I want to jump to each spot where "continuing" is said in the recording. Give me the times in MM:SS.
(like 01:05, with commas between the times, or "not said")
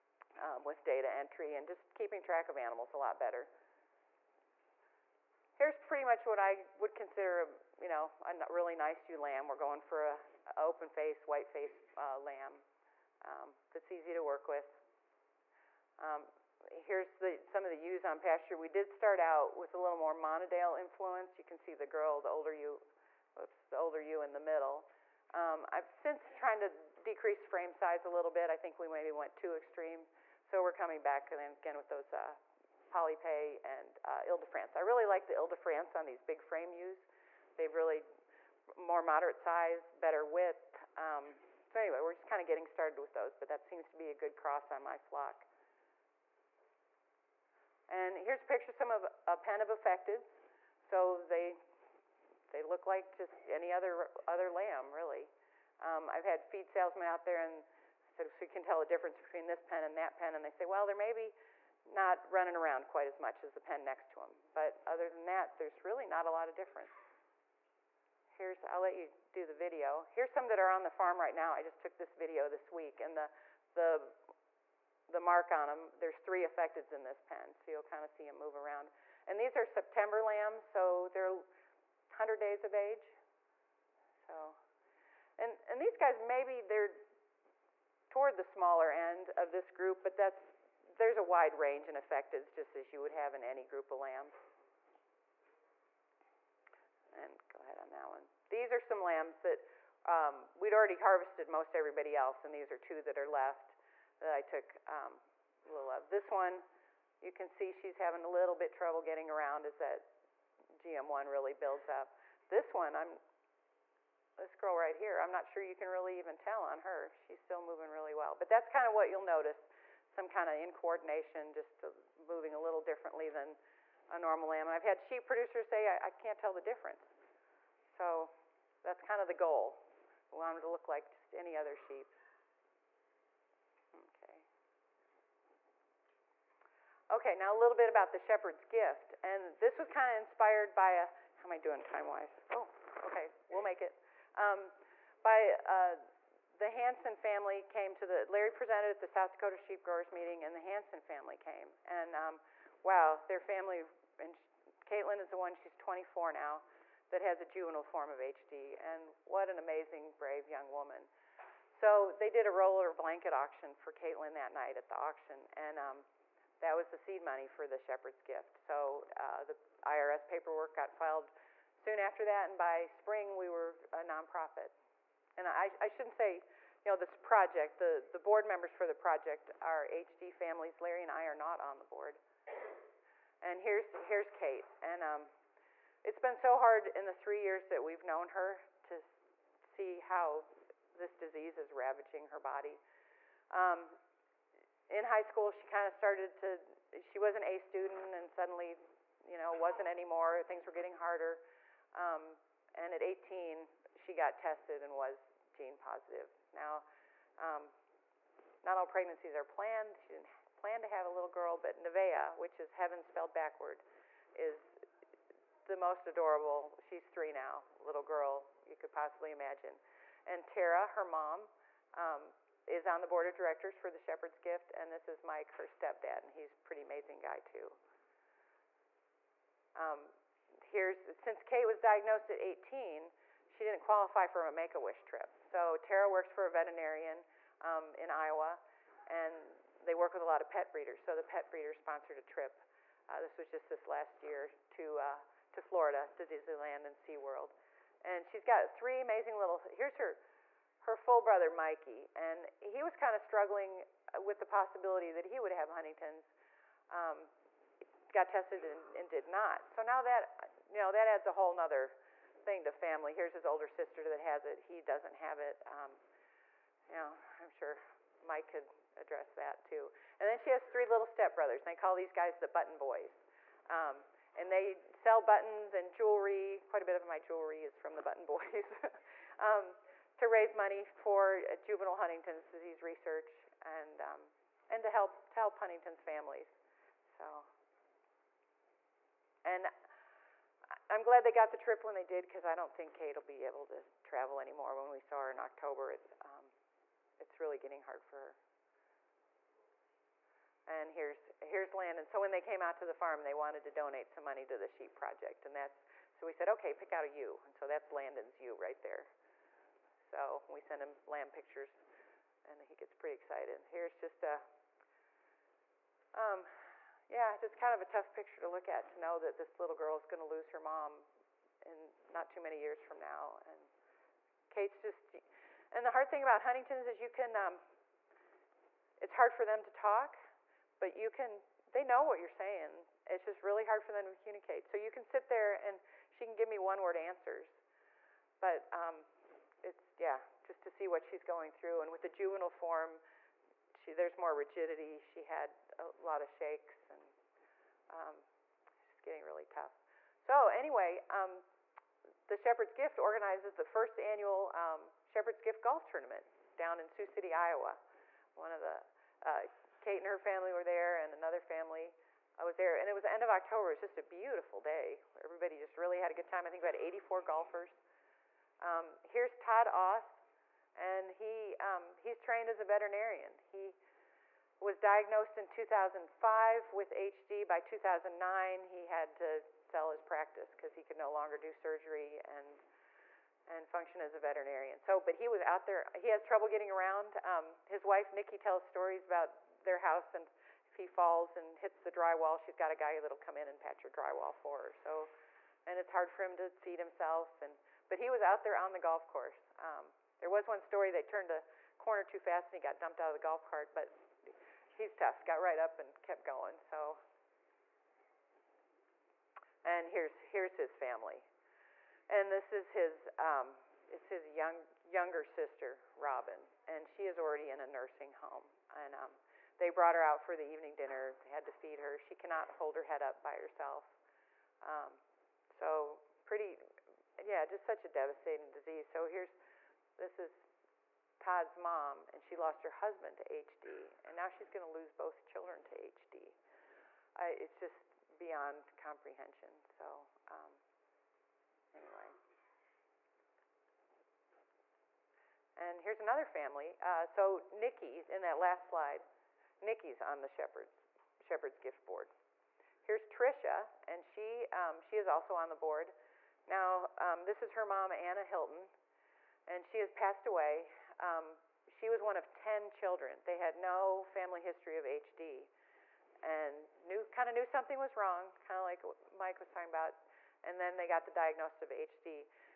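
not said.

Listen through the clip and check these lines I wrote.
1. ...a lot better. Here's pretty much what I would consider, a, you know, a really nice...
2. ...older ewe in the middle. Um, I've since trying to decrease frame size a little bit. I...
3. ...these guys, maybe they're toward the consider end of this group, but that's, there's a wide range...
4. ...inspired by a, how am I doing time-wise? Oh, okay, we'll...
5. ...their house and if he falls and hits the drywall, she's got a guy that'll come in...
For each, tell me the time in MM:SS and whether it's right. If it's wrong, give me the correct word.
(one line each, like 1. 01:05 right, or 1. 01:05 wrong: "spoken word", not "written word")
1. 00:02 right
2. 00:23 right
3. 01:25 wrong: "smaller", not "consider"
4. 02:20 right
5. 06:29 right.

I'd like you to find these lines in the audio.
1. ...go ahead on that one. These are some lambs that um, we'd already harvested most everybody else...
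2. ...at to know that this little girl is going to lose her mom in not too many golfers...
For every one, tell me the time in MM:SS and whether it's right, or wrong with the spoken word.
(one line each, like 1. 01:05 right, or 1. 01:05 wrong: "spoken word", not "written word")
1. 01:37 right
2. 05:18 wrong: "years", not "golfers".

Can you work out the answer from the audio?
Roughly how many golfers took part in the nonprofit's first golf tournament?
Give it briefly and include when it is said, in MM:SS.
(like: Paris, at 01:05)
84, at 06:06.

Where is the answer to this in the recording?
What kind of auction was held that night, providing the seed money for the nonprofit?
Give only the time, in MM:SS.
02:42.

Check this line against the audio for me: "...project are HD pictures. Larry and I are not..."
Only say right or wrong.
wrong.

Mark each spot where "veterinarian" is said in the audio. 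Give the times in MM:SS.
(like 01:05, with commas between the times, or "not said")
03:56, 06:12, 06:24.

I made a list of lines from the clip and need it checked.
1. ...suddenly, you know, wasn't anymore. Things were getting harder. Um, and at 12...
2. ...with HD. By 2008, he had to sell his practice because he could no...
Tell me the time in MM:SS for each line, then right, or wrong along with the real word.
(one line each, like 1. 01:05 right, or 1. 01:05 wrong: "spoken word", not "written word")
1. 03:18 wrong: "18", not "12"
2. 06:16 wrong: "2009", not "2008".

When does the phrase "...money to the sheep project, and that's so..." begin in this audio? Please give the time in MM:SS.
05:04.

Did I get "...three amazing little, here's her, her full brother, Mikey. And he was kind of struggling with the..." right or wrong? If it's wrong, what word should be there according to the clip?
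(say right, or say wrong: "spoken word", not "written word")
right.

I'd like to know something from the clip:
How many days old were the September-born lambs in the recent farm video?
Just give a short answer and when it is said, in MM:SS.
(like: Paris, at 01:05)
100, at 01:21.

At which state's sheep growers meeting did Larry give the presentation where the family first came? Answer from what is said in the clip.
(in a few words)
South Dakota.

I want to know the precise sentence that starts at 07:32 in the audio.
Here's Trisha, and she, um, she is also on the board.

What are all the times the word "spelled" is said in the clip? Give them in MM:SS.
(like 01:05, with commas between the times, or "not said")
03:33.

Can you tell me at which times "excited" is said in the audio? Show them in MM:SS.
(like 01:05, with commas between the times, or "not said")
05:13.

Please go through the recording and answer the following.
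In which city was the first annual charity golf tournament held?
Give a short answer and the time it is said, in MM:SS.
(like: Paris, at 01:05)
Sioux City, Iowa, at 05:56.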